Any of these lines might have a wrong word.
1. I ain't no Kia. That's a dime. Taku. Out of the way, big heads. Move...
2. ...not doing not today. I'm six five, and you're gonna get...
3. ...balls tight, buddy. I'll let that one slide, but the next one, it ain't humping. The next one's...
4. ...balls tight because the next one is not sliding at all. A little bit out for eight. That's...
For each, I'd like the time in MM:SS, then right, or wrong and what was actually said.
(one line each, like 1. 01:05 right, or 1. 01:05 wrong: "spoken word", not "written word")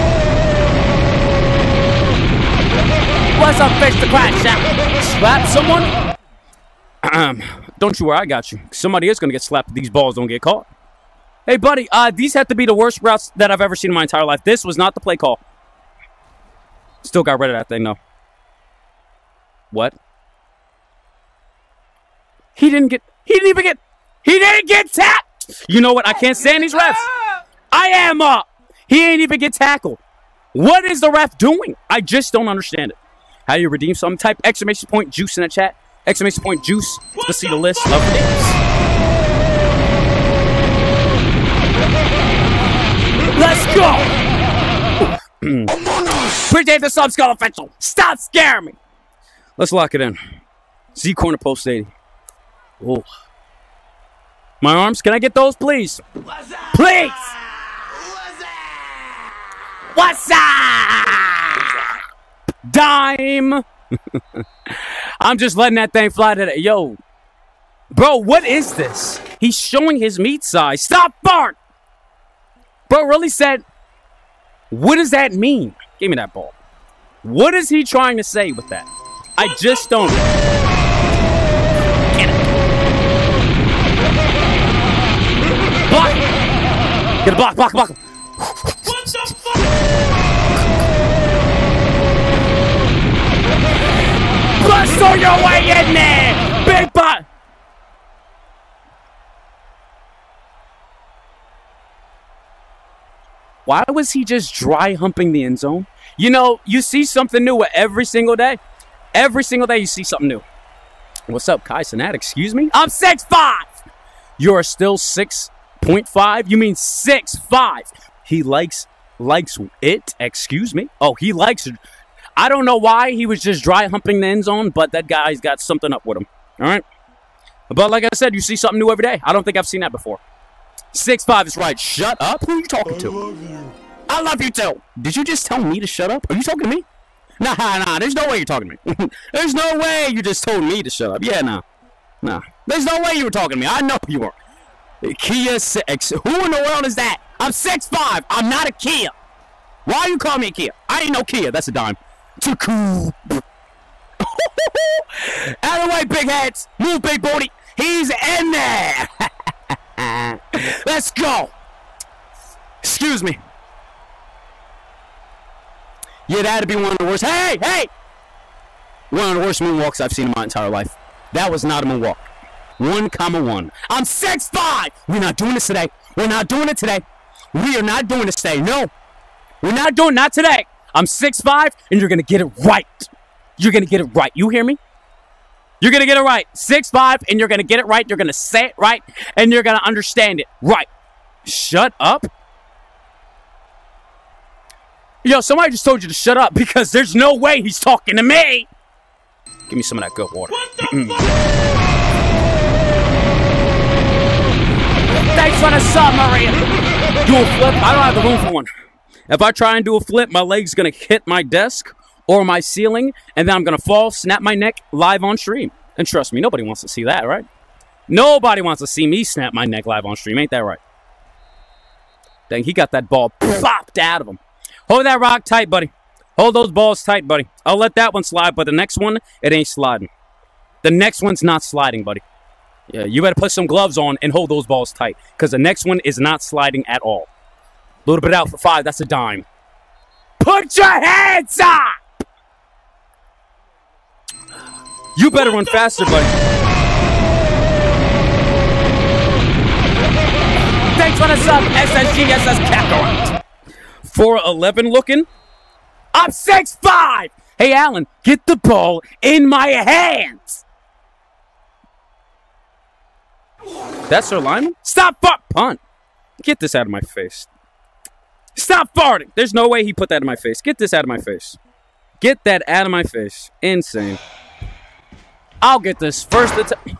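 1. 02:30 right
2. 02:59 right
3. 03:46 wrong: "sliding", not "humping"
4. 03:54 wrong: "five", not "eight".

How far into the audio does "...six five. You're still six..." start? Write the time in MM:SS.
01:52.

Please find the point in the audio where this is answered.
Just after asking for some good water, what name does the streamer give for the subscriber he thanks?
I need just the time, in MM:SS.
03:26.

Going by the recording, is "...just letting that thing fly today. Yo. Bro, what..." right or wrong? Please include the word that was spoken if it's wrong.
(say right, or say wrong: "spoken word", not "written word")
right.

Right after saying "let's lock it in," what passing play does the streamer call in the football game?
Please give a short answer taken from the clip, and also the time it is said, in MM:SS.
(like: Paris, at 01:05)
Z corner post 80, at 00:50.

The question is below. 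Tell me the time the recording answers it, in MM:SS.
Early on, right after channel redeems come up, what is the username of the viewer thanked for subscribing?
00:47.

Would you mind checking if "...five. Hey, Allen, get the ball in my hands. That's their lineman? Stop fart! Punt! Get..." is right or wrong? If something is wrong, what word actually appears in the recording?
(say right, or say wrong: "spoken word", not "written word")
right.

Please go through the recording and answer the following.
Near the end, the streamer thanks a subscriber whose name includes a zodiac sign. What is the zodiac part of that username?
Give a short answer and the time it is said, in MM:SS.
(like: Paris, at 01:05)
Capricorn, at 04:12.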